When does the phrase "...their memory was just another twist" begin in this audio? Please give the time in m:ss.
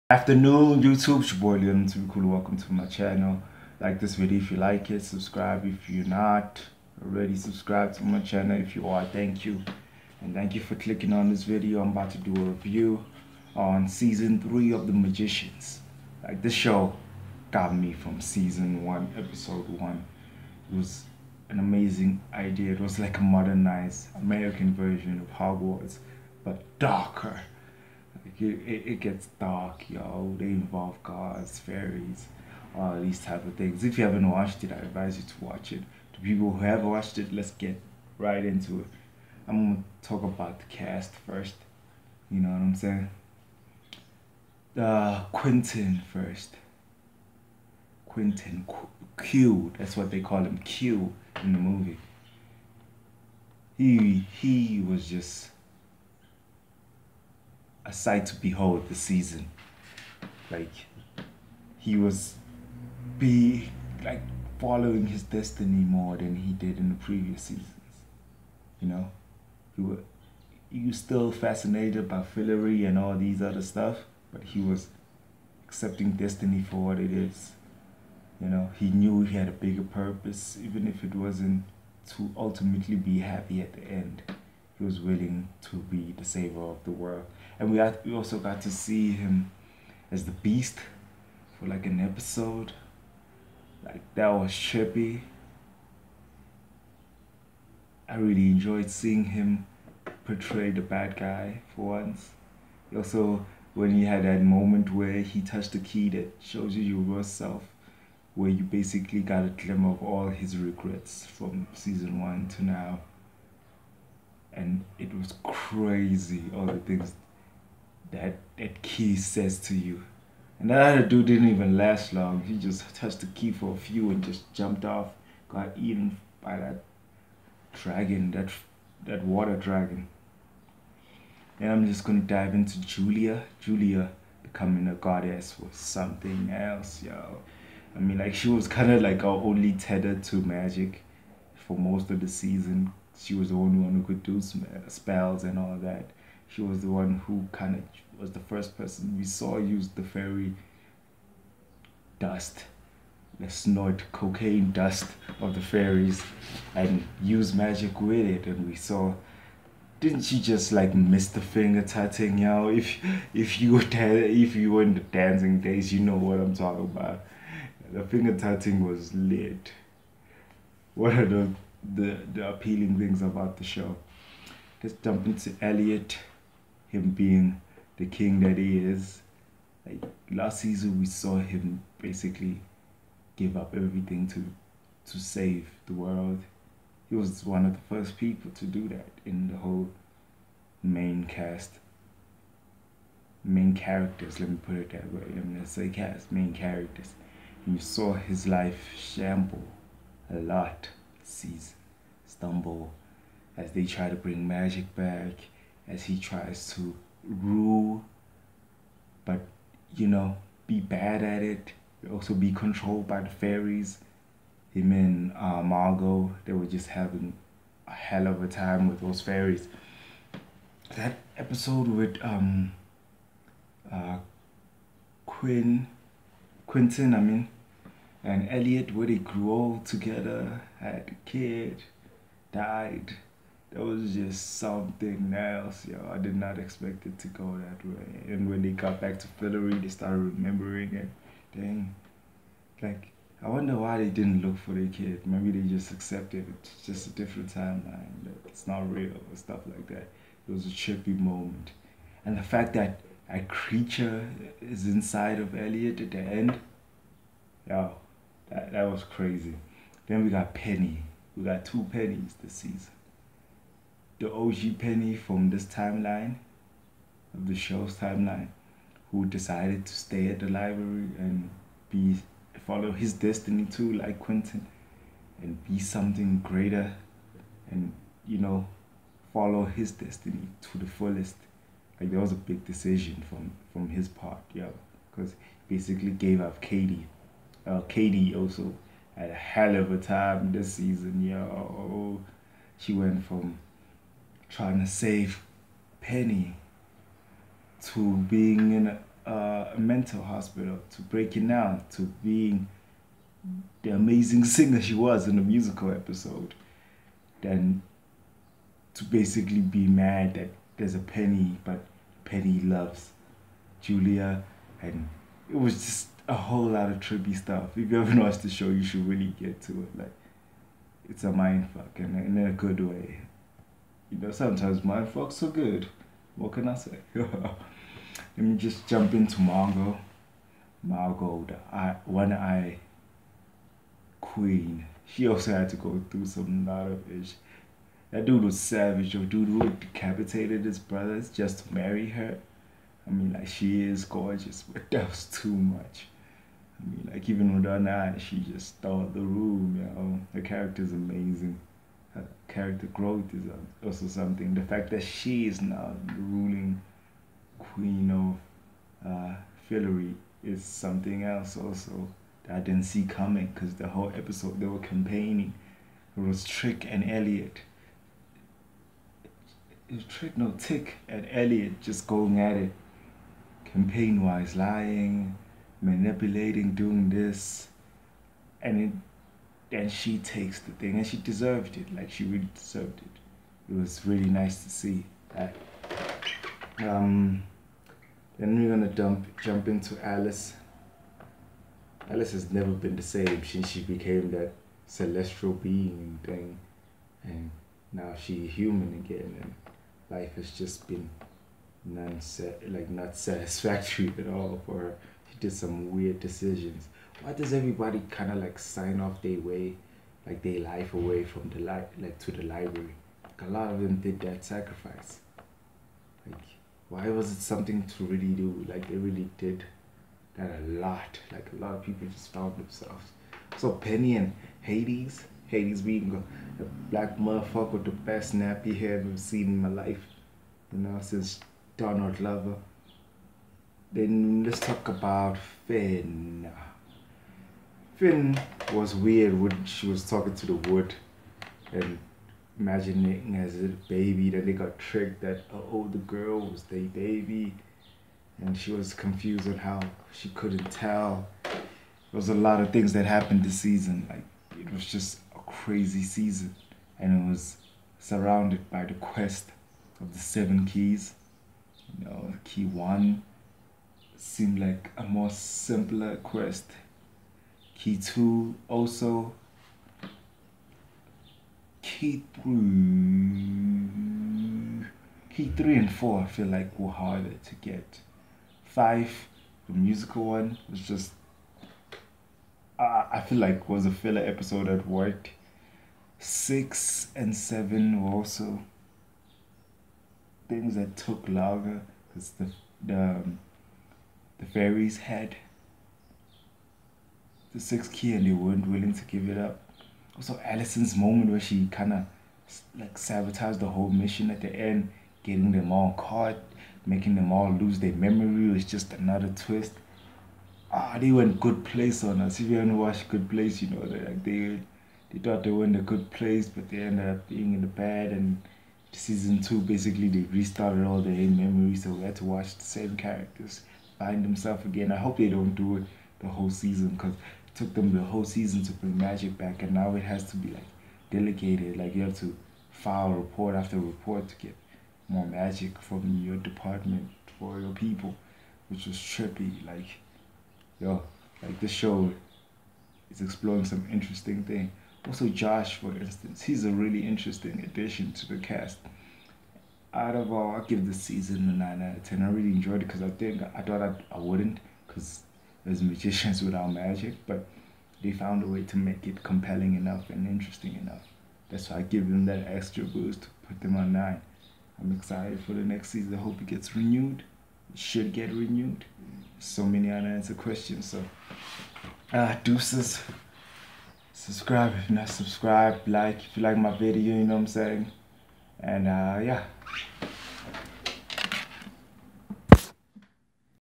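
8:27.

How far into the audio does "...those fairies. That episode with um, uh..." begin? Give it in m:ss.
3:39.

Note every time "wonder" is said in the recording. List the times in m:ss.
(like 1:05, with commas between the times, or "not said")
4:03.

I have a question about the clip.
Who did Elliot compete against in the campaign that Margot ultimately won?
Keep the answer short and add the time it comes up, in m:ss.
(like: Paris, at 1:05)
Tick, at 6:10.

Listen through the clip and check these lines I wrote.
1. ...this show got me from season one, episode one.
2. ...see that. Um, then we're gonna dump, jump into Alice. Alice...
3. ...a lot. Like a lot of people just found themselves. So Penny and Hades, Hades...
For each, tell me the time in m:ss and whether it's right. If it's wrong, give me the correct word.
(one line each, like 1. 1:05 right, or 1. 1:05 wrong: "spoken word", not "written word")
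1. 0:16 right
2. 6:24 right
3. 7:00 right.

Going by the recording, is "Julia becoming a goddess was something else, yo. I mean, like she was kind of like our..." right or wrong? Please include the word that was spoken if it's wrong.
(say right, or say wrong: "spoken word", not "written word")
right.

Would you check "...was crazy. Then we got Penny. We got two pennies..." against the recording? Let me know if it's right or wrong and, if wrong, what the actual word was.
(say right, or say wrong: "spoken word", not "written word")
right.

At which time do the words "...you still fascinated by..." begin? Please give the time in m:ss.
1:10.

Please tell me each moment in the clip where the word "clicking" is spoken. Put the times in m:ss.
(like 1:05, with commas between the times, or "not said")
0:10.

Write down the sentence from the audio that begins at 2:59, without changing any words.
Like last season, we saw him basically give up everything to to save the world.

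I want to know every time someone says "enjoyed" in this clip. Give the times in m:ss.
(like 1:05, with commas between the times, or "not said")
1:38, 9:12.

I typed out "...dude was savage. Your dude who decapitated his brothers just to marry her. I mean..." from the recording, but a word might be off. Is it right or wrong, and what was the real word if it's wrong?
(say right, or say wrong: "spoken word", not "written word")
right.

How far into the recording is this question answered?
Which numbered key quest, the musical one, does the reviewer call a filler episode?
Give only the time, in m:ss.
7:58.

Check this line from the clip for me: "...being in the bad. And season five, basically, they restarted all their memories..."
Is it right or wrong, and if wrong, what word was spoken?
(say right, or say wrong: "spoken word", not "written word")
wrong: "two", not "five".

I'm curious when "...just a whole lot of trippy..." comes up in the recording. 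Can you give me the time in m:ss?
5:15.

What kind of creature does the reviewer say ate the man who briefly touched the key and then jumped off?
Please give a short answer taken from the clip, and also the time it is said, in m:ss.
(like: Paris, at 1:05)
water dragon, at 2:09.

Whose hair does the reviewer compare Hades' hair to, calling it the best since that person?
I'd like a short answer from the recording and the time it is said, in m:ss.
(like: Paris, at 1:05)
Donald Glover, at 7:11.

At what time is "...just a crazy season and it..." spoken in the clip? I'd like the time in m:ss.
7:34.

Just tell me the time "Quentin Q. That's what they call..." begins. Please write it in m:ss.
0:48.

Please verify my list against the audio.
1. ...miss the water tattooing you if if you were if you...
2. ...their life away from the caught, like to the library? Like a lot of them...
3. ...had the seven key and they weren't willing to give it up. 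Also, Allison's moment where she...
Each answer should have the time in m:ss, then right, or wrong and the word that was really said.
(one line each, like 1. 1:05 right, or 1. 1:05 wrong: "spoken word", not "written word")
1. 2:40 wrong: "finger", not "water"
2. 6:50 wrong: "light", not "caught"
3. 8:14 wrong: "six", not "seven".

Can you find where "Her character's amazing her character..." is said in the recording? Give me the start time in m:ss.
5:50.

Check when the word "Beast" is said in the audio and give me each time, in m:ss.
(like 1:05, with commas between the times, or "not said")
1:30.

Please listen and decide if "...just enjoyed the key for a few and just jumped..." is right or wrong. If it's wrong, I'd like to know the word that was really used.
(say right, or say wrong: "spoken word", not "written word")
wrong: "touched", not "enjoyed".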